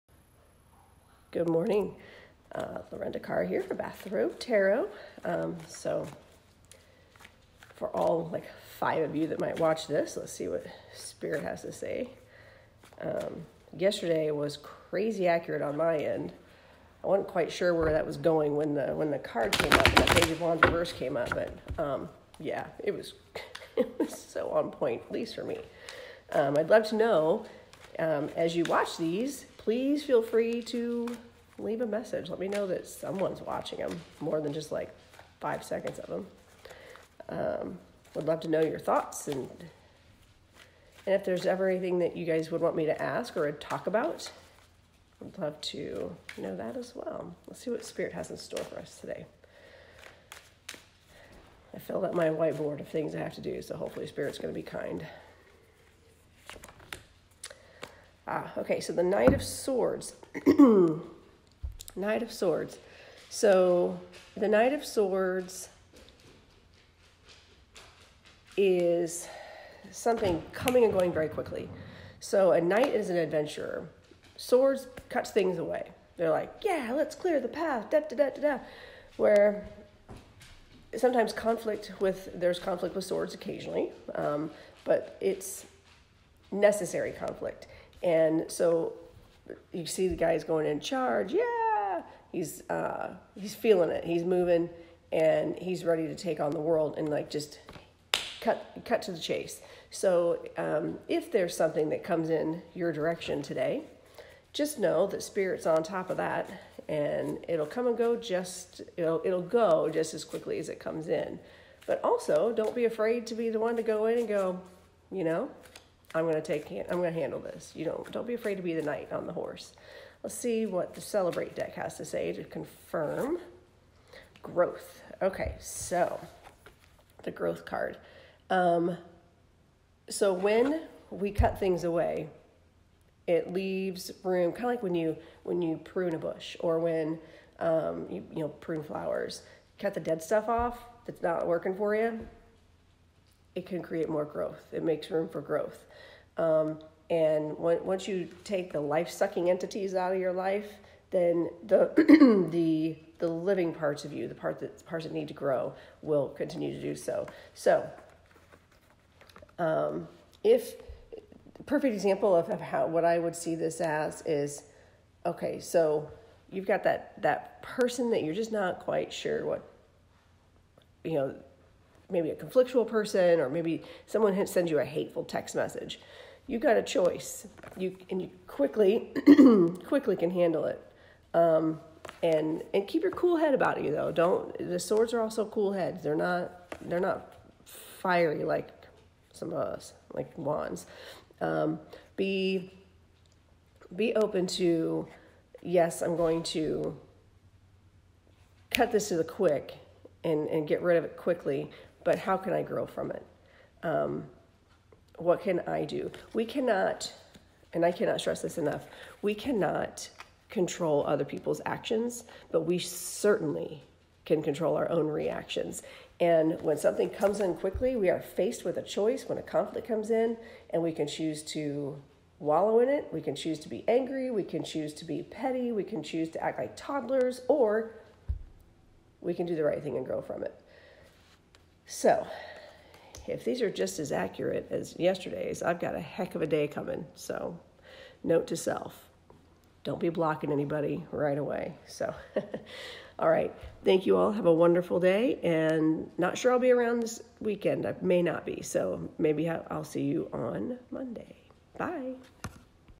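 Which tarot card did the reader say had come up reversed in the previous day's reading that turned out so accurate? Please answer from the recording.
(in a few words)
Page of Wands.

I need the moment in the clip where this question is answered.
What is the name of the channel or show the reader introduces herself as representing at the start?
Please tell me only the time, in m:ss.
0:03.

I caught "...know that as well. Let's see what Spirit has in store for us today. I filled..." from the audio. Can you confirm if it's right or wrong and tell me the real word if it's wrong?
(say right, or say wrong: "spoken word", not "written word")
right.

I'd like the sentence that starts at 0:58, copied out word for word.
Ah, okay, so the Knight of Swords.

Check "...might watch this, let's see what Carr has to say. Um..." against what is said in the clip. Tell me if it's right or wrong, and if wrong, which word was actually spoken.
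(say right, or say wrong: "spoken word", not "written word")
wrong: "Spirit", not "Carr".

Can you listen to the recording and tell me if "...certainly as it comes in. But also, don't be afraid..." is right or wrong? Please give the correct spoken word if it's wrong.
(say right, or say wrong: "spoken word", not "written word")
wrong: "quickly", not "certainly".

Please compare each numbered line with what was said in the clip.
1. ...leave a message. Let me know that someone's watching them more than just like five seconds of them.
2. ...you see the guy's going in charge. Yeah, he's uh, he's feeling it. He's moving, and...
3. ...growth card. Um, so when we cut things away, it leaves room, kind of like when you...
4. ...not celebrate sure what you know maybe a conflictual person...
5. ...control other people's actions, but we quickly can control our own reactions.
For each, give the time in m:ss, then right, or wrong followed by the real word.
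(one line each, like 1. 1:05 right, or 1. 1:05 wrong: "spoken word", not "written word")
1. 0:31 right
2. 1:29 right
3. 2:07 right
4. 2:48 wrong: "quite", not "celebrate"
5. 3:30 wrong: "certainly", not "quickly".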